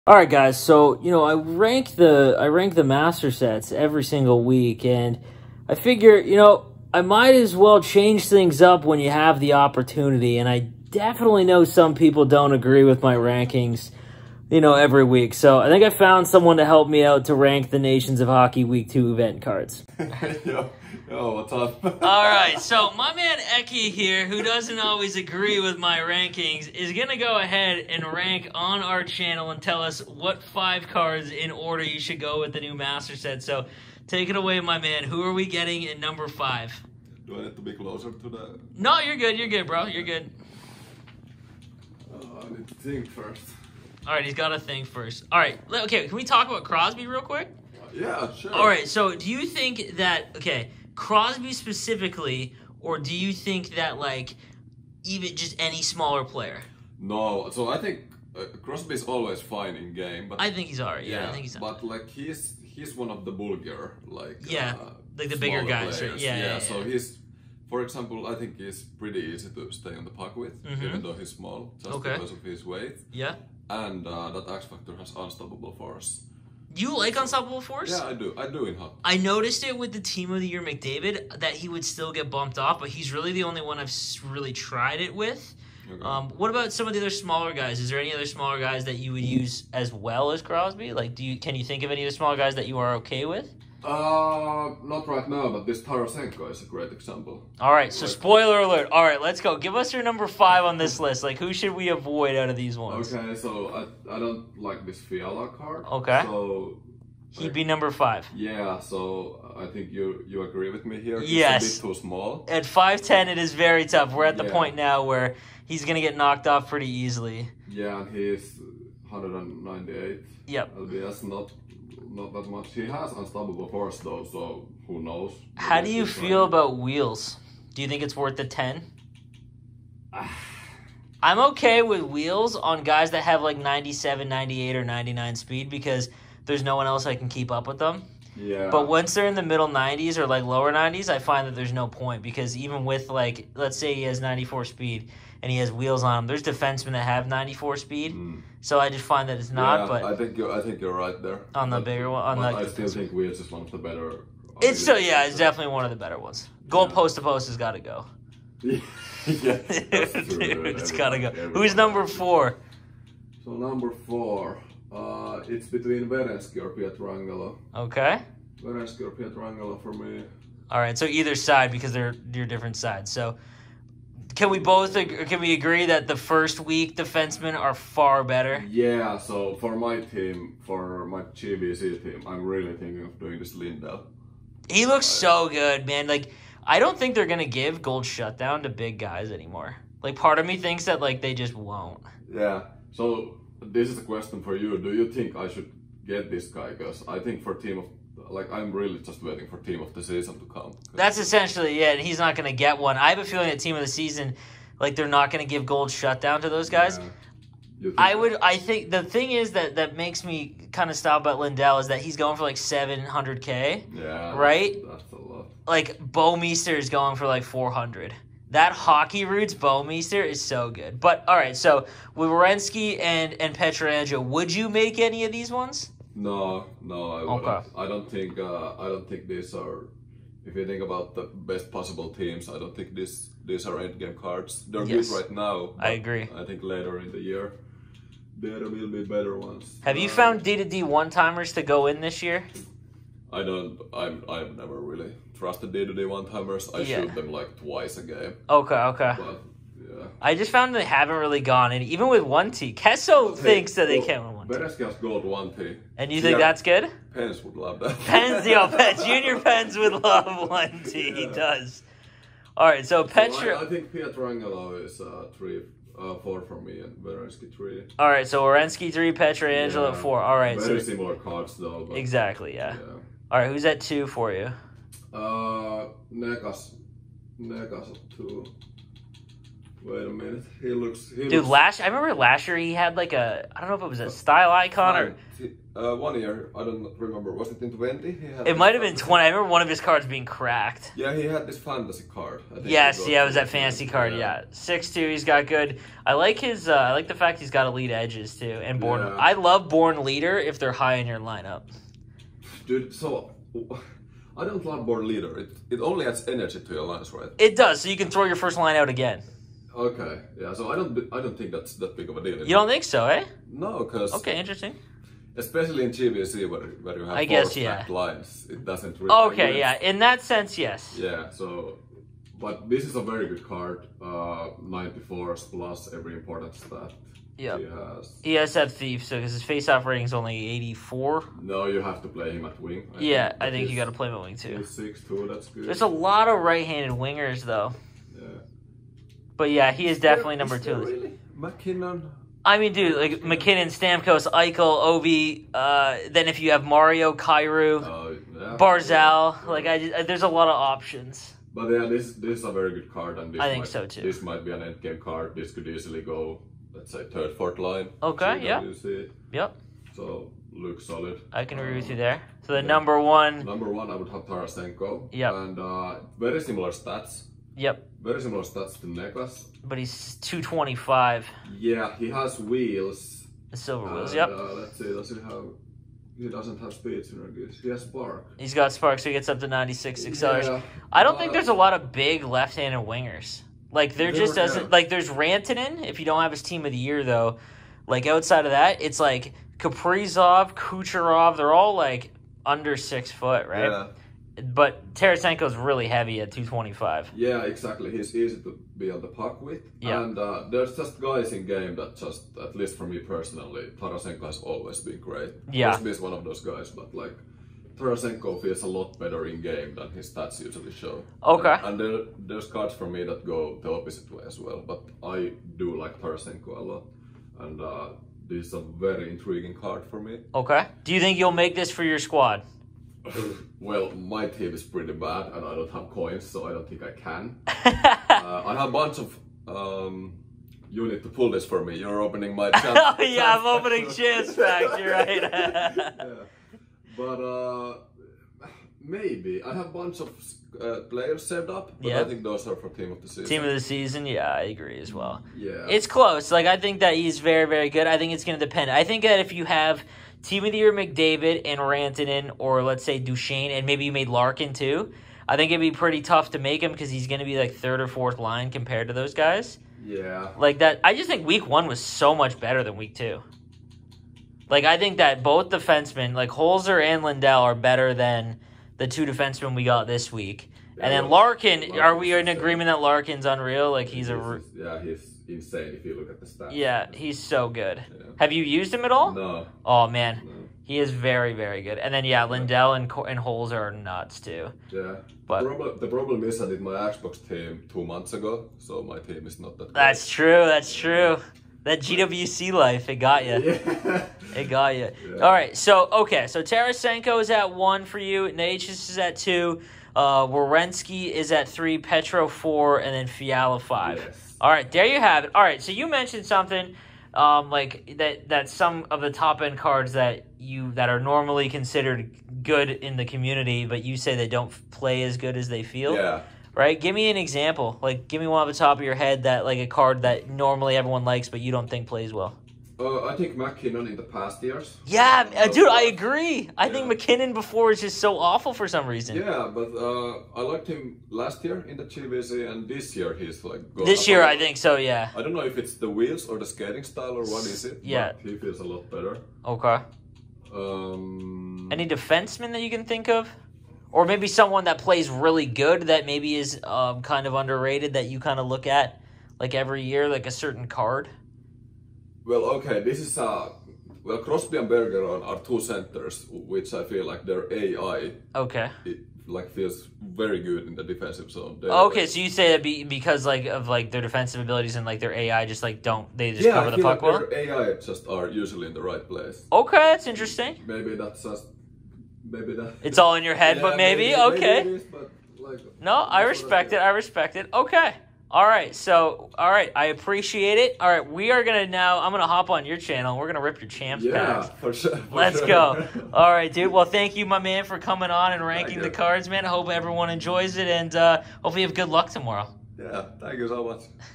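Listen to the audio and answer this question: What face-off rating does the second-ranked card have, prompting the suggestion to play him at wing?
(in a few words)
84.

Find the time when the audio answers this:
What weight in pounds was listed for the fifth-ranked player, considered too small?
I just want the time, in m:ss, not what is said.
1:59.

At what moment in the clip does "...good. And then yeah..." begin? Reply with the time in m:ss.
8:01.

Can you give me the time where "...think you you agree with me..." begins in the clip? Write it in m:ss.
1:49.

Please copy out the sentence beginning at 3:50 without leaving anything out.
If you think about the best possible teams, I don't think this these are end game cards.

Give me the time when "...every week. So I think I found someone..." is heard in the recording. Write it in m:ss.
0:14.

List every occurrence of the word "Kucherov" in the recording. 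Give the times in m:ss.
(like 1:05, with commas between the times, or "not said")
6:30.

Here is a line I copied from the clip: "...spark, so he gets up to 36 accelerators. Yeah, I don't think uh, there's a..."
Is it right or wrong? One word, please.
wrong.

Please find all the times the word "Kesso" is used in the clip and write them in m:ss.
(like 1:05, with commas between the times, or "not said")
4:12.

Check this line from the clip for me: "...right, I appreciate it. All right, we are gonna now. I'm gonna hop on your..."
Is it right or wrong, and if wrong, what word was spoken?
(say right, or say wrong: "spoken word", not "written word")
right.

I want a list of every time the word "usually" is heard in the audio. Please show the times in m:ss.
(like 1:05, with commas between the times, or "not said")
6:50, 9:28.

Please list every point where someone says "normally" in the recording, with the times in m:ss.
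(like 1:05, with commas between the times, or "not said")
8:30, 8:40.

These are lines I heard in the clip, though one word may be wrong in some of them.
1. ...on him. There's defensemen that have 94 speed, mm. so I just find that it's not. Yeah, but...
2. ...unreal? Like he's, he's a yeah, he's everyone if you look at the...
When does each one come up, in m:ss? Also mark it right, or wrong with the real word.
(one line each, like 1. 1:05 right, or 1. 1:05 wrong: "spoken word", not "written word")
1. 2:26 right
2. 7:53 wrong: "insane", not "everyone".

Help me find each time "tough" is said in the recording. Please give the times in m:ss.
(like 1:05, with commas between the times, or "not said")
1:53, 7:36.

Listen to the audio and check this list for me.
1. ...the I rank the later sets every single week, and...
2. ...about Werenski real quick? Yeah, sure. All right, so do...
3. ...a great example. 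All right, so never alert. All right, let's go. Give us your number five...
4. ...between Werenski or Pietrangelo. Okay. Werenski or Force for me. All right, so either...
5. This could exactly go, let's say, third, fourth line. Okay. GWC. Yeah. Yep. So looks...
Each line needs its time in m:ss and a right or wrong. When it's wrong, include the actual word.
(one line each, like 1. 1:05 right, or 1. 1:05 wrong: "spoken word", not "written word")
1. 0:01 wrong: "master", not "later"
2. 0:46 wrong: "Crosby", not "Werenski"
3. 1:36 wrong: "spoiler", not "never"
4. 2:45 wrong: "Pietrangelo", not "Force"
5. 5:55 wrong: "easily", not "exactly".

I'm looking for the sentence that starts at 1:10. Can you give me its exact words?
even though he's small, just okay.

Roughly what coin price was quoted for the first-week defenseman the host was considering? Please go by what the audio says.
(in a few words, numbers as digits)
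700k.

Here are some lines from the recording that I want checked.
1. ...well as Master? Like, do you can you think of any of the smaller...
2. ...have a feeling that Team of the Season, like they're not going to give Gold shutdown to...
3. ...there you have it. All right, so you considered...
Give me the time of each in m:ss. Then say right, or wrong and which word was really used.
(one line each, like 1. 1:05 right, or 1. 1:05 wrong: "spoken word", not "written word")
1. 1:29 wrong: "Crosby", not "Master"
2. 3:23 right
3. 8:24 wrong: "mentioned", not "considered".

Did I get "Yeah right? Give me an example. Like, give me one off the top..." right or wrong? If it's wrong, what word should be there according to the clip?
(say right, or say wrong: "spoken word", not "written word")
right.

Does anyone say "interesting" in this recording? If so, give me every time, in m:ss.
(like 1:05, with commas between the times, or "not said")
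5:14, 9:30.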